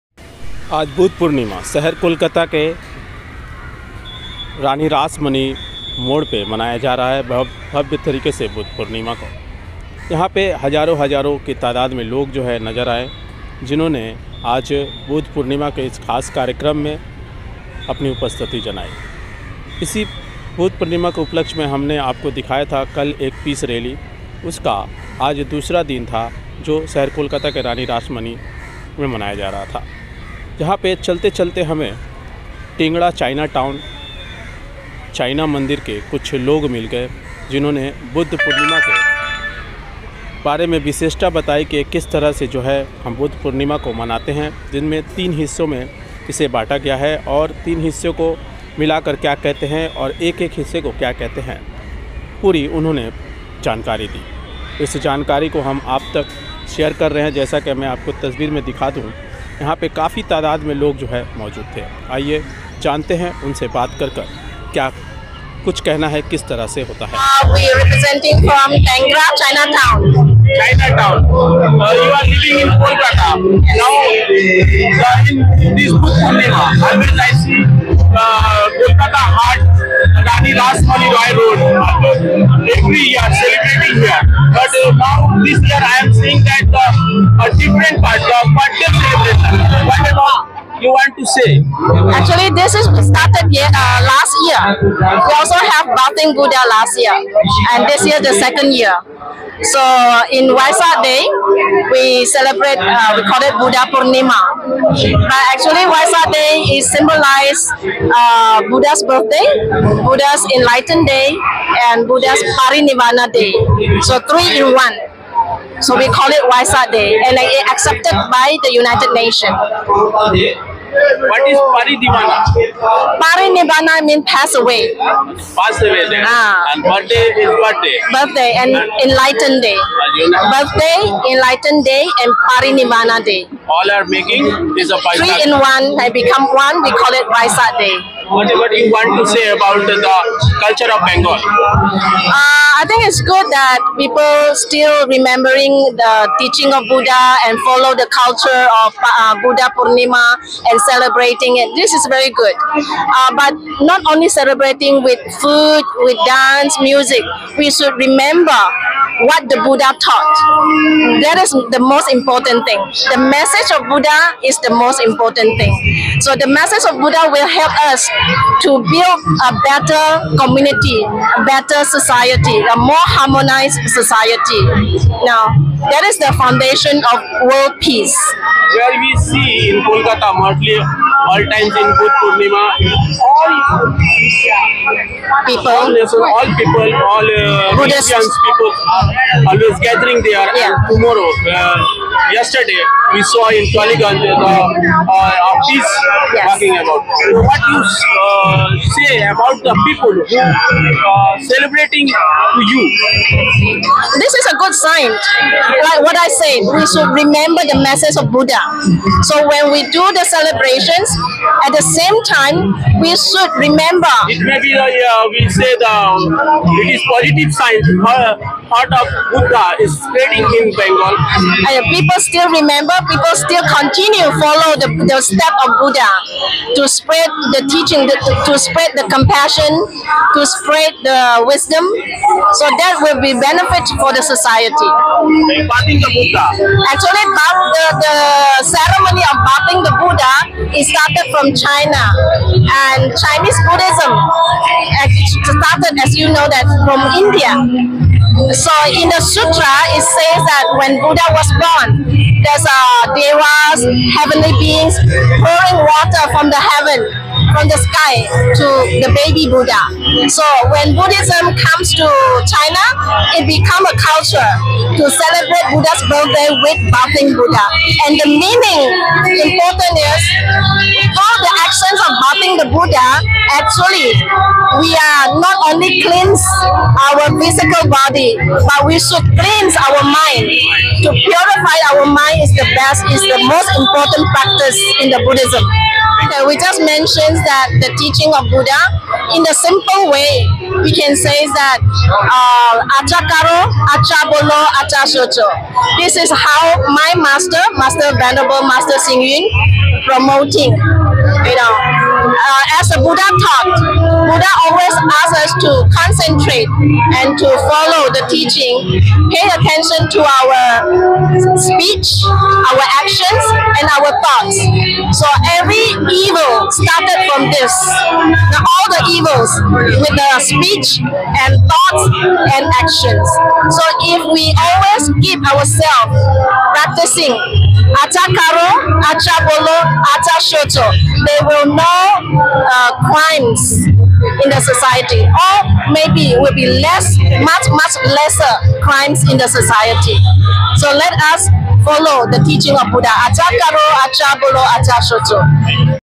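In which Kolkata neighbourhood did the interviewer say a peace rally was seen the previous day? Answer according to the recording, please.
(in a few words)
Tollygunge.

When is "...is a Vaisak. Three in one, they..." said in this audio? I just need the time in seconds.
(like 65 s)
134 s.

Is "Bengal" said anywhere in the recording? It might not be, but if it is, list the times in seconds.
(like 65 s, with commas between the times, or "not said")
141 s, 220 s.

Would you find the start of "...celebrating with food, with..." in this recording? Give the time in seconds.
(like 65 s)
154 s.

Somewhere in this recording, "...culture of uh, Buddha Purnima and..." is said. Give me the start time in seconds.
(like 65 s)
148 s.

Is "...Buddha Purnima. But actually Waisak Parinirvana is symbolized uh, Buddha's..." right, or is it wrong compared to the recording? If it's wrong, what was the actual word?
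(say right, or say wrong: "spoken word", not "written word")
wrong: "Day", not "Parinirvana".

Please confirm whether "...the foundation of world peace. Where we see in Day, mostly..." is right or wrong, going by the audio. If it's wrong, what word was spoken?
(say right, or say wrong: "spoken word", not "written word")
wrong: "Kolkata", not "Day".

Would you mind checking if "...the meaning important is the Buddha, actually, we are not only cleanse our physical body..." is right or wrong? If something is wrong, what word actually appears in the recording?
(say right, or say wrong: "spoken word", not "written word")
right.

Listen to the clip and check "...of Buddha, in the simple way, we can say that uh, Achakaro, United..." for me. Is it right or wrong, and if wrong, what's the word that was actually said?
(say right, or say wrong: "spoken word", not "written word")
wrong: "Achabolo", not "United".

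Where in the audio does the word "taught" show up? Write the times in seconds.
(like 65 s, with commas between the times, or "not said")
160 s, 303 s.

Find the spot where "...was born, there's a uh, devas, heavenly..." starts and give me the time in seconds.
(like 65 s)
251 s.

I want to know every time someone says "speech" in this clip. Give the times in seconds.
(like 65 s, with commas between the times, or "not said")
311 s, 320 s.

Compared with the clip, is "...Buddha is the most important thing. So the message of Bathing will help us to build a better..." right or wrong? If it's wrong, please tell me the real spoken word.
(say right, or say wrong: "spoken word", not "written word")
wrong: "Buddha", not "Bathing".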